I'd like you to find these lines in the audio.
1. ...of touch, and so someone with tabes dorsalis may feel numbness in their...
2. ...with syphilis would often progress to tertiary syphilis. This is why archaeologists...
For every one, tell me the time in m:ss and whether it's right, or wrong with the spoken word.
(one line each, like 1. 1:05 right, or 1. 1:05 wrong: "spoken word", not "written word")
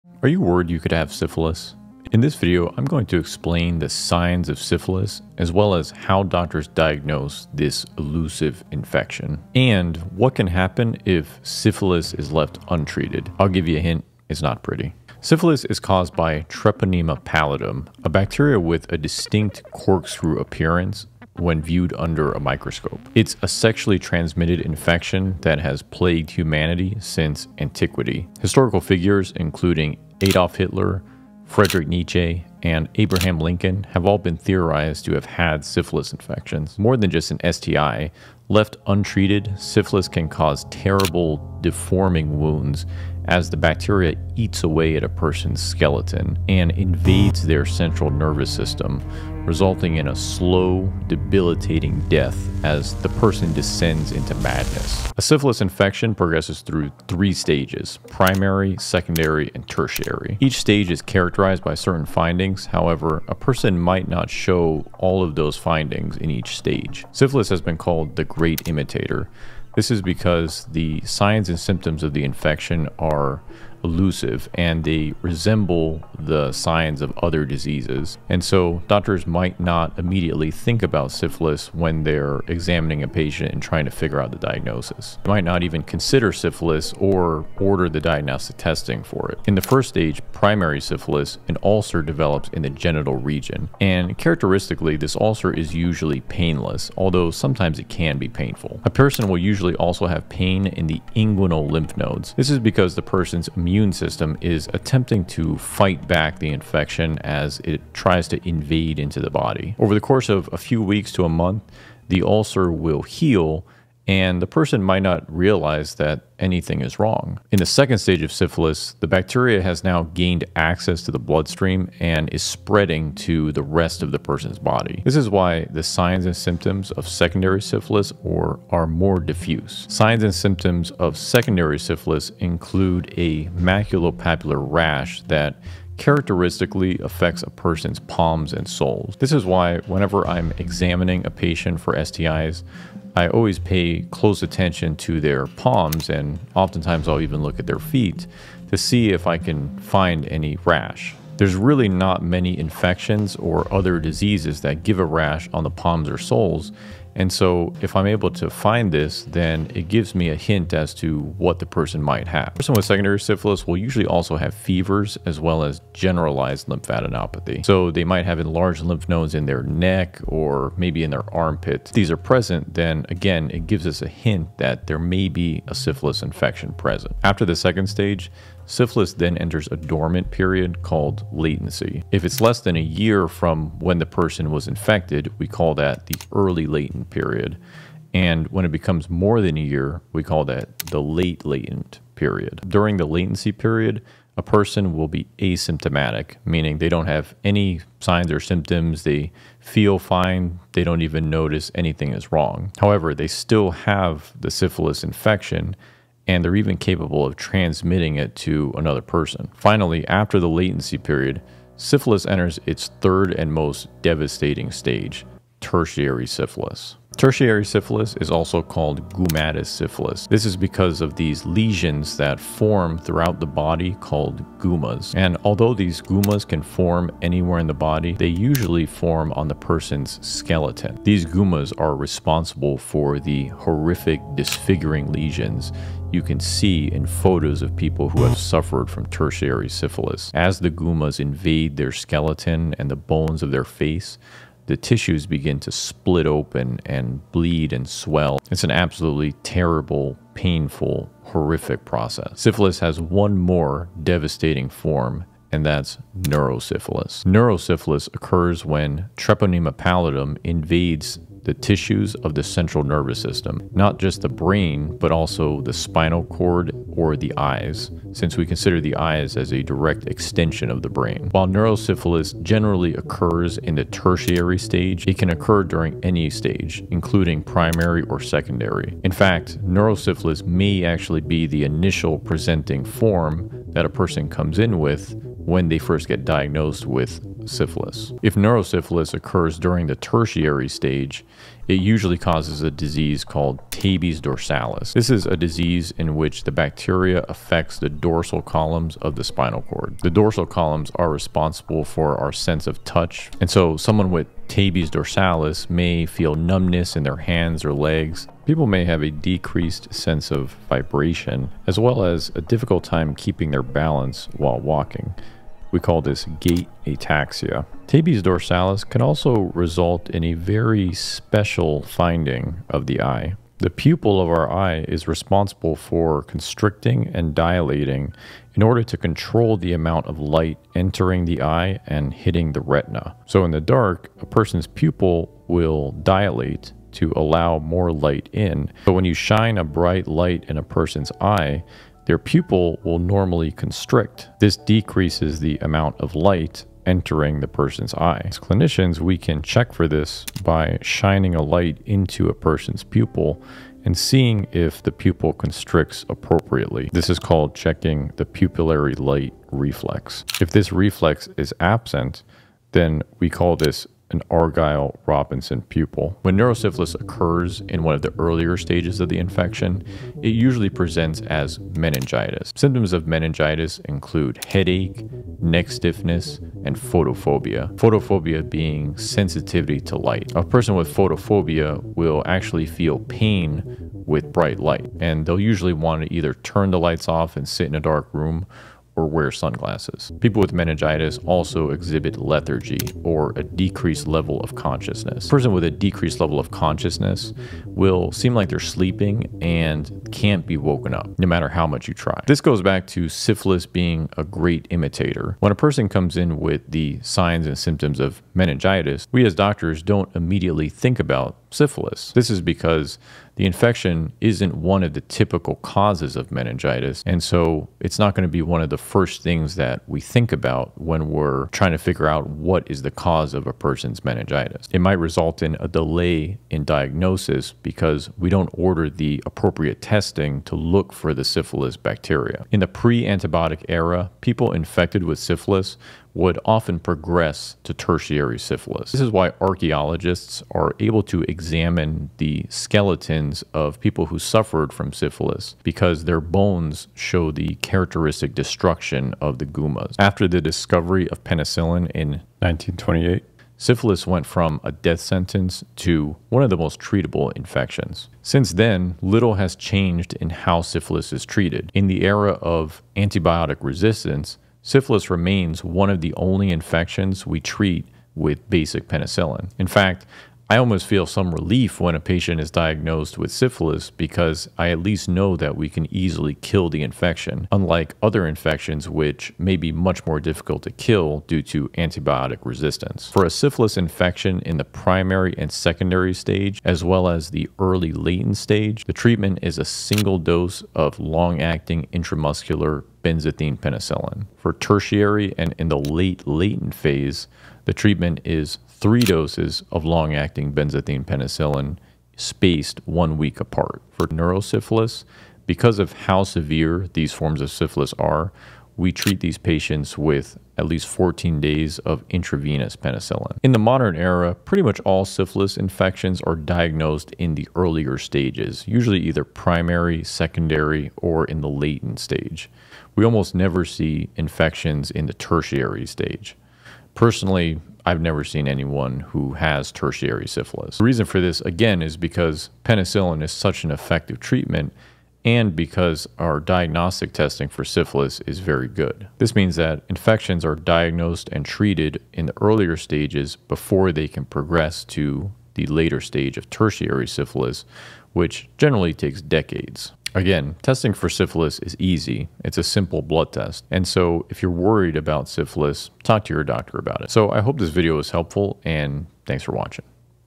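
1. 5:02 right
2. 7:15 right.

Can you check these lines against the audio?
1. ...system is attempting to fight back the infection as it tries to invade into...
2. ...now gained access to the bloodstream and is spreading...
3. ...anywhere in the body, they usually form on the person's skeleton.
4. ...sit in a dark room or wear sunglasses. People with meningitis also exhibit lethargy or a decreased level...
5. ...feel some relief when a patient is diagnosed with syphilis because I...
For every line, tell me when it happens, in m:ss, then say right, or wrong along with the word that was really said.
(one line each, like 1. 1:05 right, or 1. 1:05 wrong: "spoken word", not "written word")
1. 1:43 right
2. 1:59 right
3. 3:47 right
4. 6:27 right
5. 7:50 right.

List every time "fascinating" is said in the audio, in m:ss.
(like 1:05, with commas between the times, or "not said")
not said.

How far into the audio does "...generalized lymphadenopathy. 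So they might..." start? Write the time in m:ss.
2:45.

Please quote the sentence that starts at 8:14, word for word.
For tertiary and in the late latent phase, the treatment is three doses of long acting benzathine penicillin spaced one week apart.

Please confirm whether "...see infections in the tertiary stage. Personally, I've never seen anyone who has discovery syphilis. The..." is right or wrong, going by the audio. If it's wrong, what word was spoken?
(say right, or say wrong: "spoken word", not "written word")
wrong: "tertiary", not "discovery".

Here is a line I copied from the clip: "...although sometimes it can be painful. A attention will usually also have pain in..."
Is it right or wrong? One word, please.
wrong.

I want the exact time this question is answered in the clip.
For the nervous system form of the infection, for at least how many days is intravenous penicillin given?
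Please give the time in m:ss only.
8:30.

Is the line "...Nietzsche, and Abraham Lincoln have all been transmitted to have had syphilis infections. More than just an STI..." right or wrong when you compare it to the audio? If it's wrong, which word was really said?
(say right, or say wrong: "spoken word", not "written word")
wrong: "theorized", not "transmitted".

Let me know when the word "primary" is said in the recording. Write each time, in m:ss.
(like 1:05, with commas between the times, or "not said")
0:58, 1:30, 4:37, 8:04, 8:39.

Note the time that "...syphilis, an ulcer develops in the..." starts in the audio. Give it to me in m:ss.
1:30.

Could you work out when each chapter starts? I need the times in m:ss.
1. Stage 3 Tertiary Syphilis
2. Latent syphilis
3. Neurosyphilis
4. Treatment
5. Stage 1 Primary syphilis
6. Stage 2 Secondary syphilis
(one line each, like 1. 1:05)
1. 3:26
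2. 2:56
3. 4:12
4. 7:40
5. 1:30
6. 1:58.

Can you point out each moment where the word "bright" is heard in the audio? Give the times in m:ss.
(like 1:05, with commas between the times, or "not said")
5:39, 6:24.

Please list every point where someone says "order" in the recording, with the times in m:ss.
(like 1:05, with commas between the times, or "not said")
1:27, 5:28, 7:08.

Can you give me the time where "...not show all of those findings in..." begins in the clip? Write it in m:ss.
1:04.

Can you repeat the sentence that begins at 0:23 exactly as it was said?
It's a sexually transmitted infection that has plagued humanity since antiquity.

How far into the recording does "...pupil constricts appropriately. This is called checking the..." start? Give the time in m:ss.
5:54.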